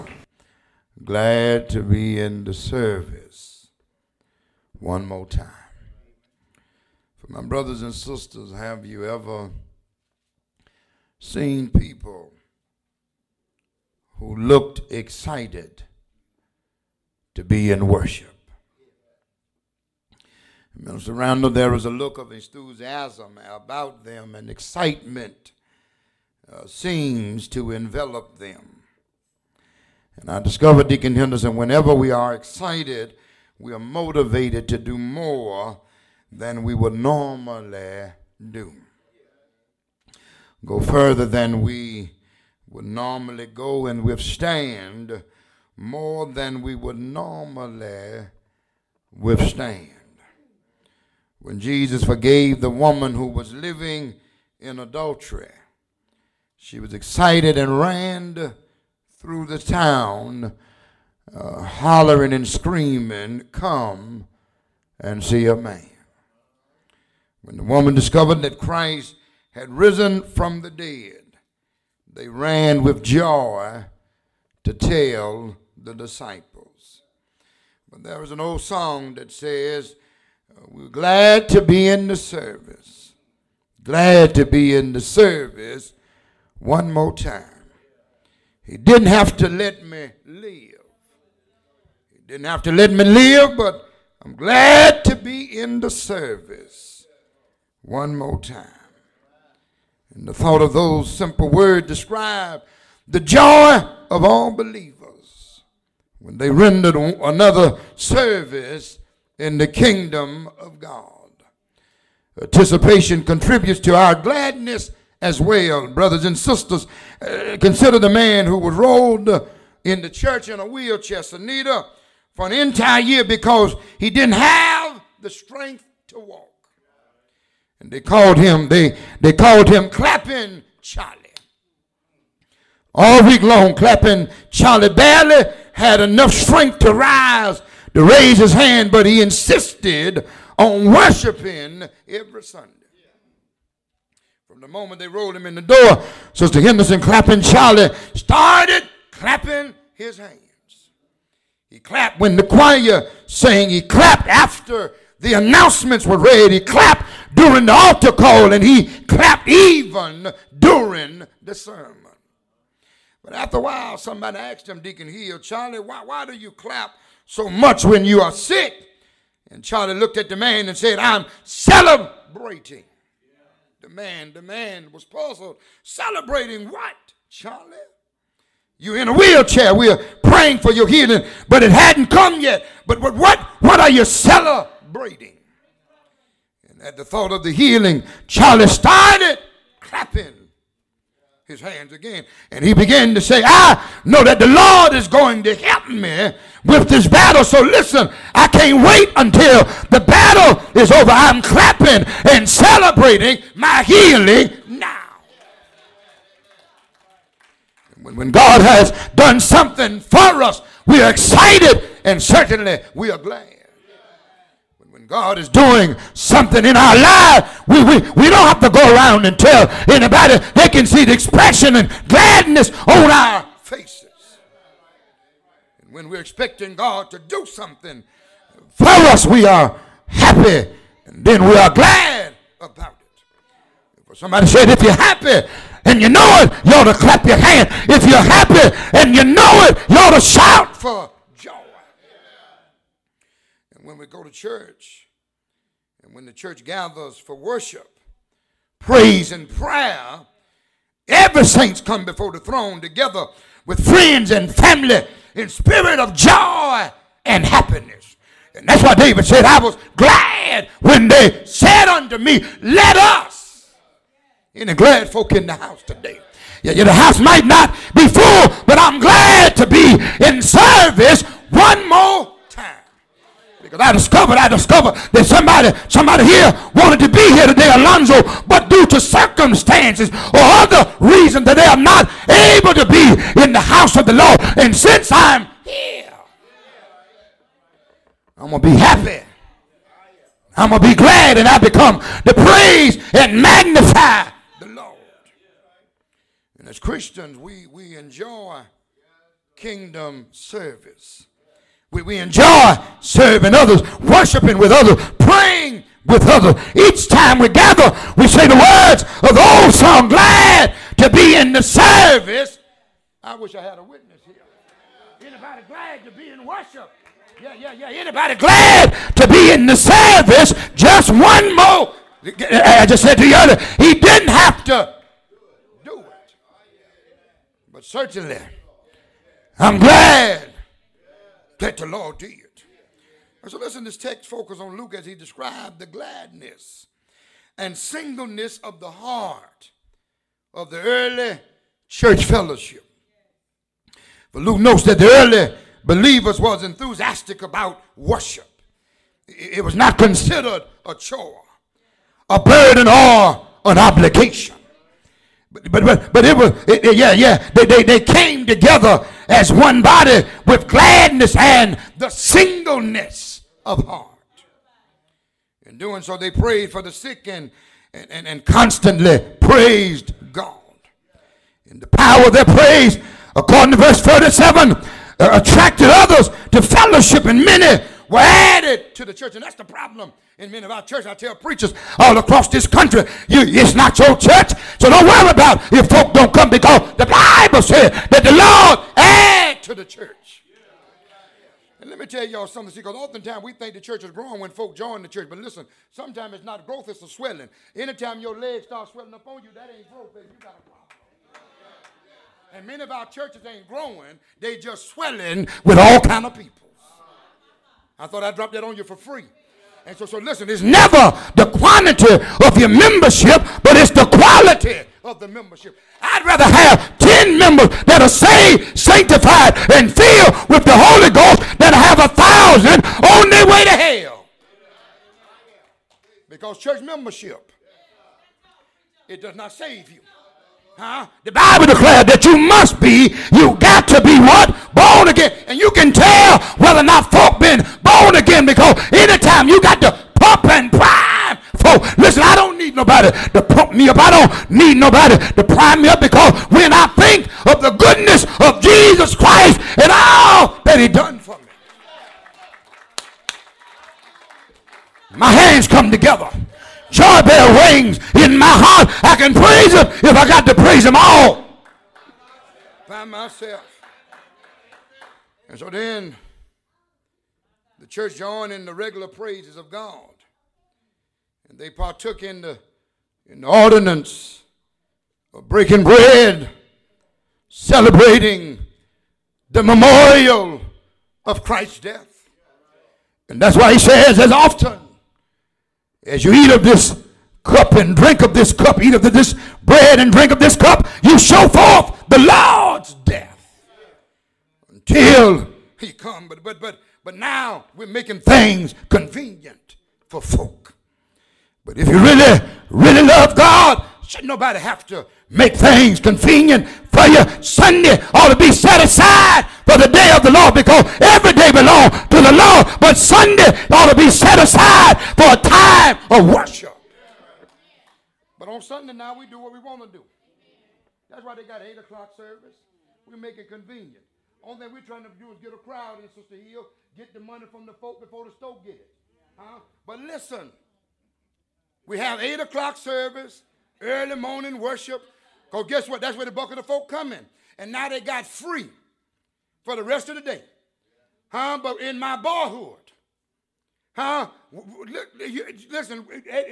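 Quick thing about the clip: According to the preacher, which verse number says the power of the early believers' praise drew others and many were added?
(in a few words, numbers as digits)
37.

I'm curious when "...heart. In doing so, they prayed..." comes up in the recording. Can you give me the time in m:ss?
6:03.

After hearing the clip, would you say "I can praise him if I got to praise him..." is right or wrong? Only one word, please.
right.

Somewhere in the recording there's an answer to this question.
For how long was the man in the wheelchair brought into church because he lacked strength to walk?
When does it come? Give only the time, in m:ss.
2:02.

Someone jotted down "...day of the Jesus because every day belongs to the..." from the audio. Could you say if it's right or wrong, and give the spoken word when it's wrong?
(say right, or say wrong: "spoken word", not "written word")
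wrong: "Lord", not "Jesus".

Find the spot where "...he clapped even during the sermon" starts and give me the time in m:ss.
2:38.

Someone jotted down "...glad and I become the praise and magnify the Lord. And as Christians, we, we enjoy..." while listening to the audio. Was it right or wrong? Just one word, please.
right.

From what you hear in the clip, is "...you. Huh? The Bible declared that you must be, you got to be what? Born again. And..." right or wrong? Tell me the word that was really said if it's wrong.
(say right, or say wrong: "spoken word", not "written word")
right.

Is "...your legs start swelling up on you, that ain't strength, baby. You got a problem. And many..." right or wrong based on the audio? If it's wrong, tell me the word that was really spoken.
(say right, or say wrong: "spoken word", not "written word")
wrong: "growth", not "strength".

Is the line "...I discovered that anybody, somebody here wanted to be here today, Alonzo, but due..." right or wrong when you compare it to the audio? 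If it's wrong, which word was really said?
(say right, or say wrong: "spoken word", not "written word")
wrong: "somebody", not "anybody".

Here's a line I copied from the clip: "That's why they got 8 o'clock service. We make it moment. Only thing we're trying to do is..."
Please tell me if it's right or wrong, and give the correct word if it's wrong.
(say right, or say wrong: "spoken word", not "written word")
wrong: "convenient", not "moment".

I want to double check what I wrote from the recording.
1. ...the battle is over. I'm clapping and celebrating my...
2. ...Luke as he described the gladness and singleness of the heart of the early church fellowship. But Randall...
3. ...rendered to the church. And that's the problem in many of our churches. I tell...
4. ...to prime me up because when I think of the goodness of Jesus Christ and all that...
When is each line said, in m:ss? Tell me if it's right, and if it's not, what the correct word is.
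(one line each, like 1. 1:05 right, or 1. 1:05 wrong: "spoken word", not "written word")
1. 3:19 right
2. 5:34 wrong: "Luke", not "Randall"
3. 6:18 wrong: "added", not "rendered"
4. 7:25 right.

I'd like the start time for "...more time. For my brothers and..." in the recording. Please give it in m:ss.
0:05.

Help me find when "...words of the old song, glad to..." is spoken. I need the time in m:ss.
5:08.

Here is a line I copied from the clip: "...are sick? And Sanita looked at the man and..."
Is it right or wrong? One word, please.
wrong.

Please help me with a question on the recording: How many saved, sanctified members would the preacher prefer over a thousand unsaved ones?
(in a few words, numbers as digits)
10.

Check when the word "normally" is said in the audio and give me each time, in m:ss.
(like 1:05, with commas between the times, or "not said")
0:36, 0:42, 0:46.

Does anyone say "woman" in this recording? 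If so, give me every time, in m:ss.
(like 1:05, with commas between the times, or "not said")
0:52, 1:07.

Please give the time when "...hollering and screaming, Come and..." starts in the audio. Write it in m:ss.
1:01.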